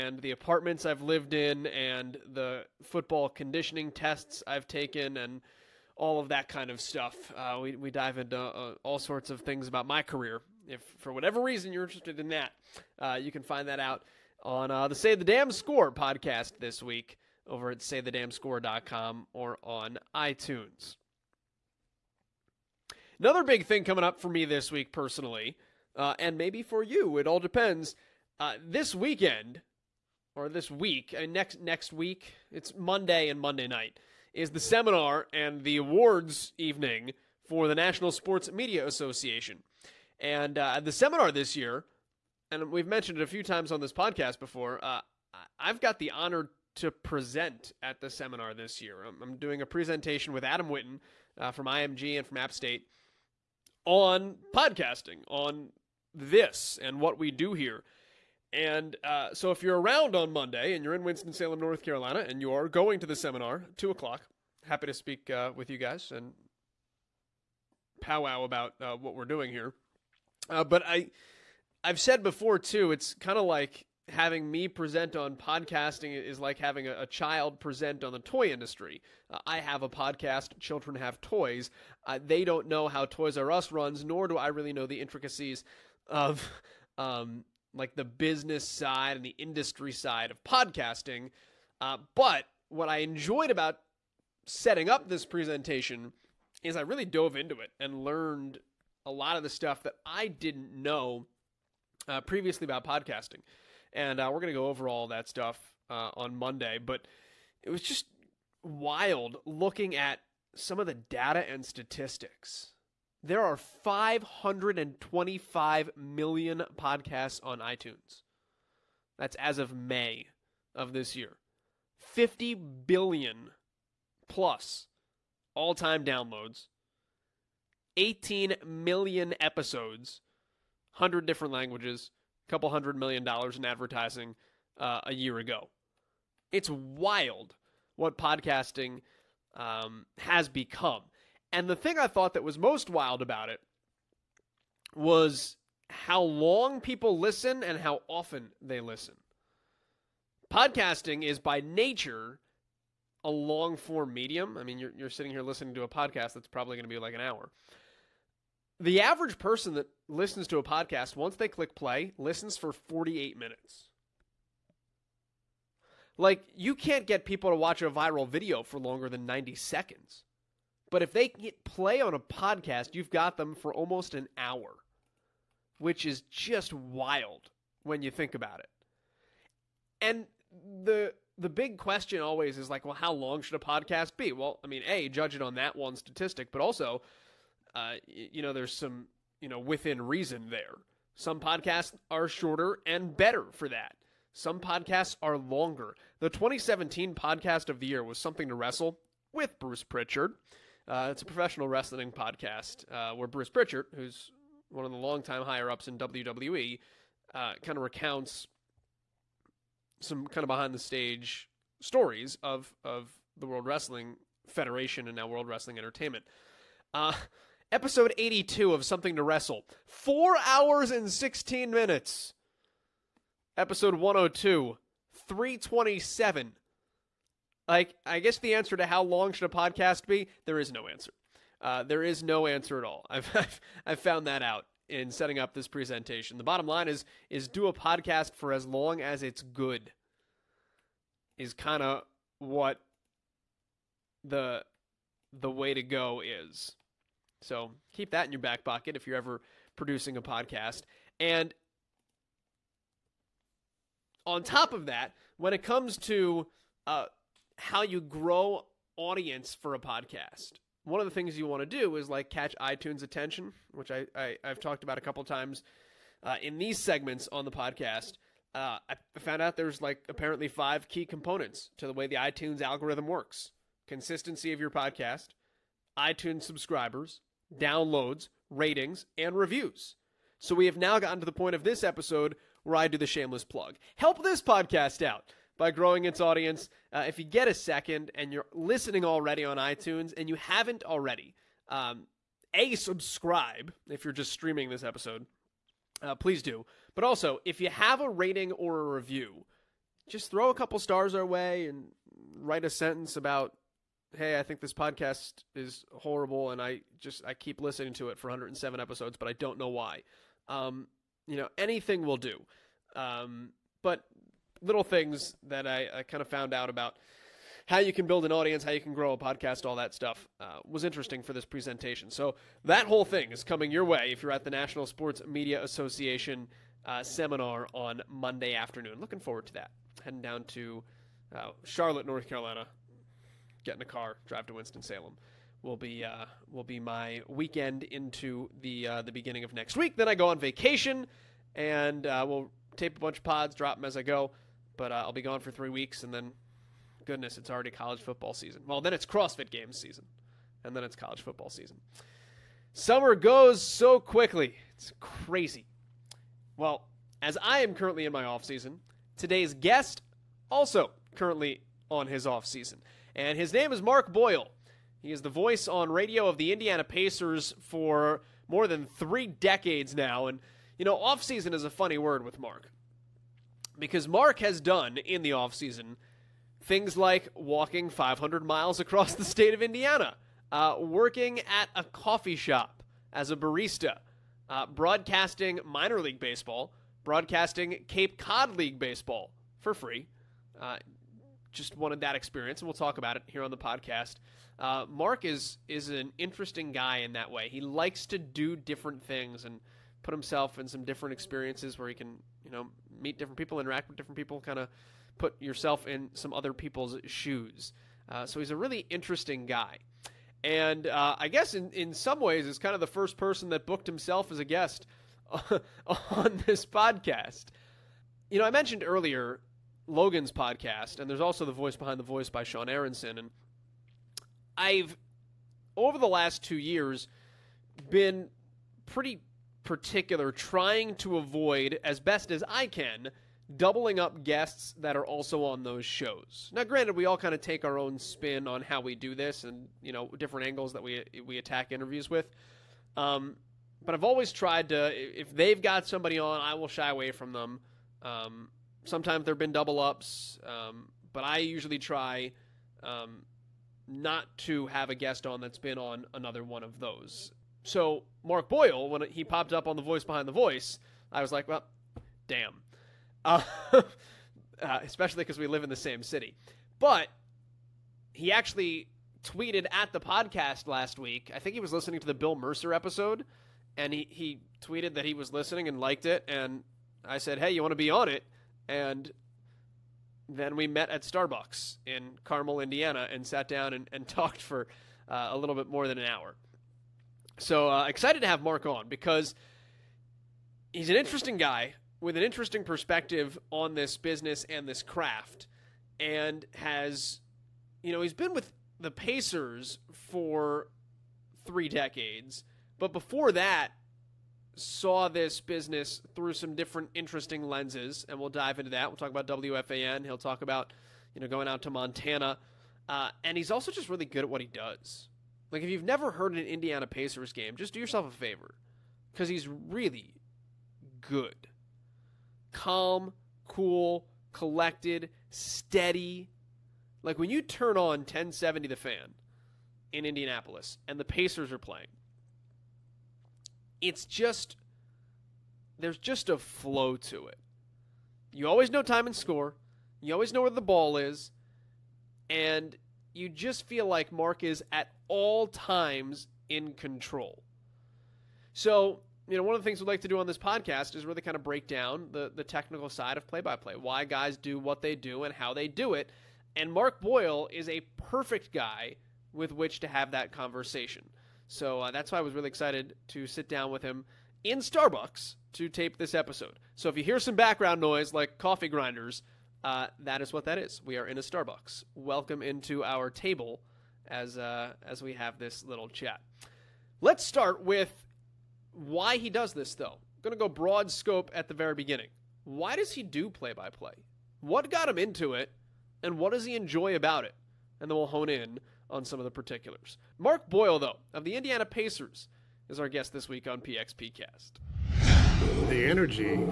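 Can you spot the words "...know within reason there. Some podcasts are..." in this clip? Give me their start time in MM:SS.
03:09.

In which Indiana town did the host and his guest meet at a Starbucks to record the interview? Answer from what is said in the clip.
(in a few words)
Carmel.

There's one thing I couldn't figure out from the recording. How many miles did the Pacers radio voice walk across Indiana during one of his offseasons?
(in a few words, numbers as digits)
500.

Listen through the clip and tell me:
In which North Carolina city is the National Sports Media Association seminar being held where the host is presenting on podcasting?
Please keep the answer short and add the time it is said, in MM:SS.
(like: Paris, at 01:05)
Winston-Salem, at 01:01.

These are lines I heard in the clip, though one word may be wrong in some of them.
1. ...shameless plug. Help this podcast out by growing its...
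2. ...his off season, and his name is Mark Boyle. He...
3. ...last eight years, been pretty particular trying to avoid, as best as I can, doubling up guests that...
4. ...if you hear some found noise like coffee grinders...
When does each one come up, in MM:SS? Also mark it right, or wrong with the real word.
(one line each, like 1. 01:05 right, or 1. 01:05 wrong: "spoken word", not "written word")
1. 04:43 right
2. 06:02 right
3. 07:06 wrong: "two", not "eight"
4. 09:26 wrong: "background", not "found".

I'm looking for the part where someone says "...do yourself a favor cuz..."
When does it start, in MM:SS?
08:37.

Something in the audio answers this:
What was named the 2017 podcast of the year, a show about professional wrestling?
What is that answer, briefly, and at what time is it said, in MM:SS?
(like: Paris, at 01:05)
Something to Wrestle with Bruce Pritchard, at 03:18.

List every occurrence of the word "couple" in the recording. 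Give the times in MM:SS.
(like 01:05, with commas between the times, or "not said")
02:12, 04:25, 05:00.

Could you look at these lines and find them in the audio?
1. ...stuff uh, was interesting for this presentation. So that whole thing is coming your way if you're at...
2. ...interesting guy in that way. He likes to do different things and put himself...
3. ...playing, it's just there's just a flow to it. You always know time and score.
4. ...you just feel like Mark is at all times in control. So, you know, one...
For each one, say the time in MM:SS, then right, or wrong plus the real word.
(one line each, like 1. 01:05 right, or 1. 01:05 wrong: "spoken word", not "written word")
1. 05:19 right
2. 06:36 right
3. 08:51 right
4. 09:03 right.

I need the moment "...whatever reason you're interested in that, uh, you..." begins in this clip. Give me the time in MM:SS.
00:11.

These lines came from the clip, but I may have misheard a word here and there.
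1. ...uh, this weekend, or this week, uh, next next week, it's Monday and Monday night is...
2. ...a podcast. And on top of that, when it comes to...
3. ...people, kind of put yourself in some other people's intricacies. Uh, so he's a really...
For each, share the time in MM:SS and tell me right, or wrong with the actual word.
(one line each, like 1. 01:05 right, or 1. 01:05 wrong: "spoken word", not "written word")
1. 00:28 right
2. 04:10 right
3. 06:44 wrong: "shoes", not "intricacies".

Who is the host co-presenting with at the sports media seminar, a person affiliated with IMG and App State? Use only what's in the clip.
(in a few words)
Adam Witten.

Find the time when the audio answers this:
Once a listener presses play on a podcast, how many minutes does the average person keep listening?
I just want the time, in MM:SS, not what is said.
02:42.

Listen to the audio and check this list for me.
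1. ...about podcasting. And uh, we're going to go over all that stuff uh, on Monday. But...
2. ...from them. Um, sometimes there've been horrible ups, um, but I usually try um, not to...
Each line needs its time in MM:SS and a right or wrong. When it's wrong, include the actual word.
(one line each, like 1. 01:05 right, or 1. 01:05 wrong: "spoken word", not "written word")
1. 01:42 right
2. 07:27 wrong: "double", not "horrible".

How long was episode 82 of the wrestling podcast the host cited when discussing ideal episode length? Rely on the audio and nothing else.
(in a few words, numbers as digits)
4 hours and 16 minutes.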